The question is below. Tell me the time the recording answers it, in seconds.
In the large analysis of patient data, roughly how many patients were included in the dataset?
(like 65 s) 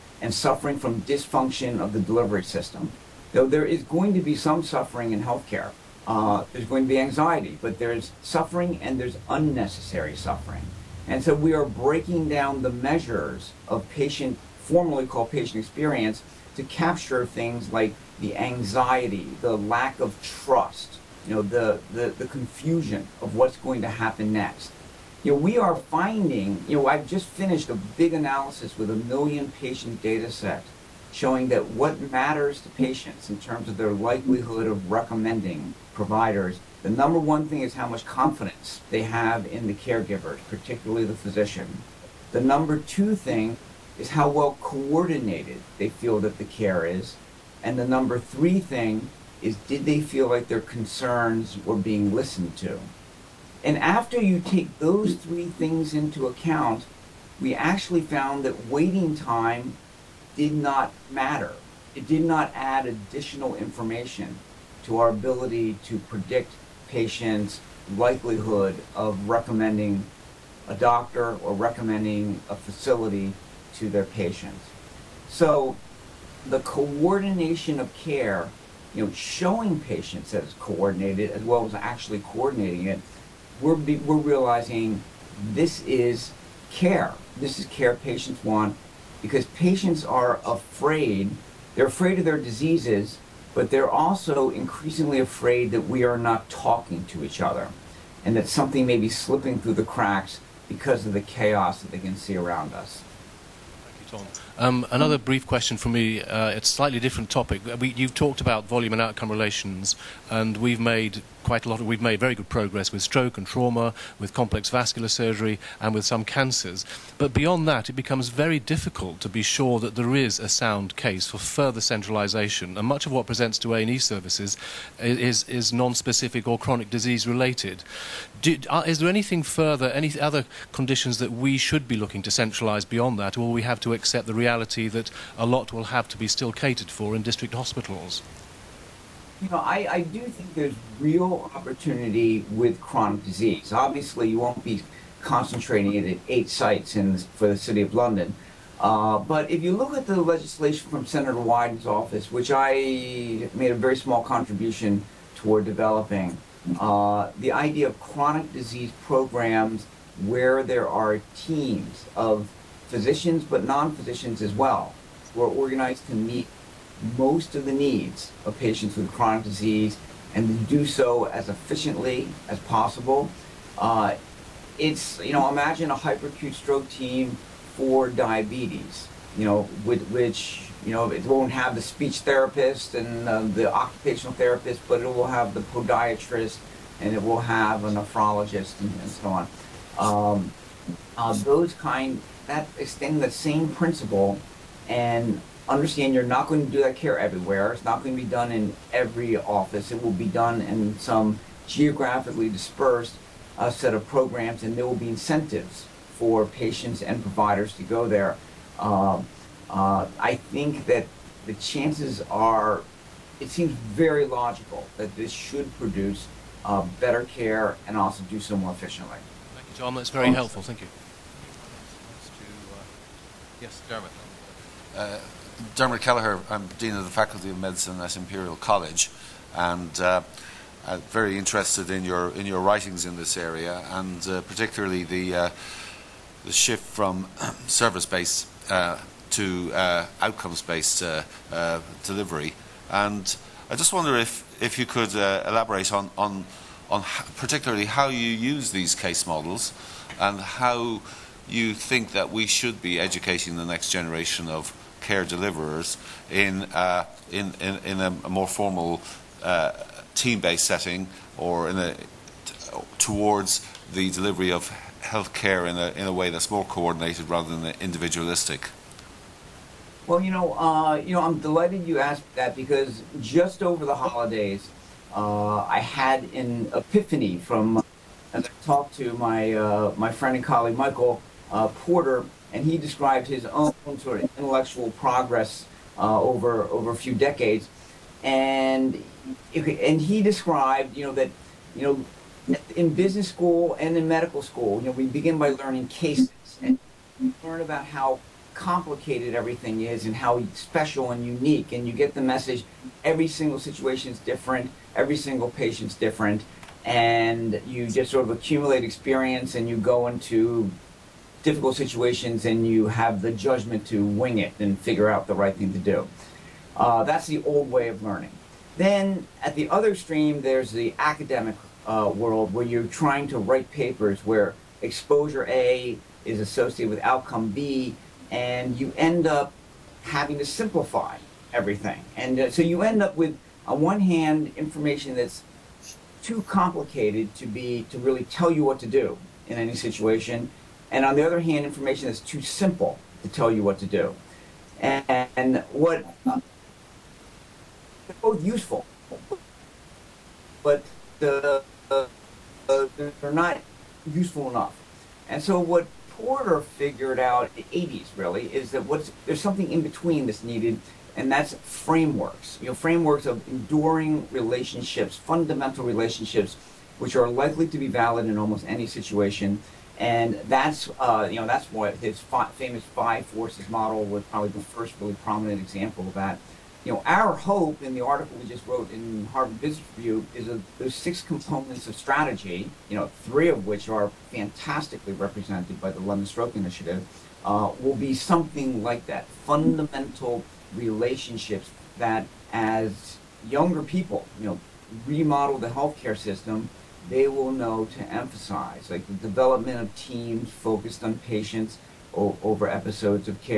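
28 s.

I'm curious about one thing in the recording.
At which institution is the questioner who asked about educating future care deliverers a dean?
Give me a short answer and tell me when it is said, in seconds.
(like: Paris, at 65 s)
Imperial College, at 228 s.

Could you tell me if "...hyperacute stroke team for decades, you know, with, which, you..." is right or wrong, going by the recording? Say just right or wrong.
wrong.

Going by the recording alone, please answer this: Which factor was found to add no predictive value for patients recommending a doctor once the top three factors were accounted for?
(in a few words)
Waiting time.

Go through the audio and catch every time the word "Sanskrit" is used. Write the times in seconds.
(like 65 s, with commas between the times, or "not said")
not said.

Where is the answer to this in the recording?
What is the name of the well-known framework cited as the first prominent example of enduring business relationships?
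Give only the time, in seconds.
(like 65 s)
372 s.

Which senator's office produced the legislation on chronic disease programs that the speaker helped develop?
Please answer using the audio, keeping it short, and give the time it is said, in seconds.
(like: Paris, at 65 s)
Senator Wyden, at 151 s.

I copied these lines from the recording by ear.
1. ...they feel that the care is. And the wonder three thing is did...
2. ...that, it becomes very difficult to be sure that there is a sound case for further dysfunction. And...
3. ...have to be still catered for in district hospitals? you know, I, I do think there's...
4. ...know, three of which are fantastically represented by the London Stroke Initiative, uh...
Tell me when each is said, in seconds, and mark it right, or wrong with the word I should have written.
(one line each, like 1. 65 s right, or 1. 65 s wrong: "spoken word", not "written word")
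1. 45 s wrong: "number", not "wonder"
2. 117 s wrong: "centralisation", not "dysfunction"
3. 135 s right
4. 382 s right.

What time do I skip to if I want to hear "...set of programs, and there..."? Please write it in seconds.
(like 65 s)
203 s.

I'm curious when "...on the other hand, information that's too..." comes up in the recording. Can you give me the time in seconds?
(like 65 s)
341 s.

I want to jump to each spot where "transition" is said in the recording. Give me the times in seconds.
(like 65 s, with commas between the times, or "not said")
not said.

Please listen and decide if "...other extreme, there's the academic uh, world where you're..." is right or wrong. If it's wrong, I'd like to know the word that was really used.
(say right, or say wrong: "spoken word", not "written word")
right.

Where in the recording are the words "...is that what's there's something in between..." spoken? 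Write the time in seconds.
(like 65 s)
358 s.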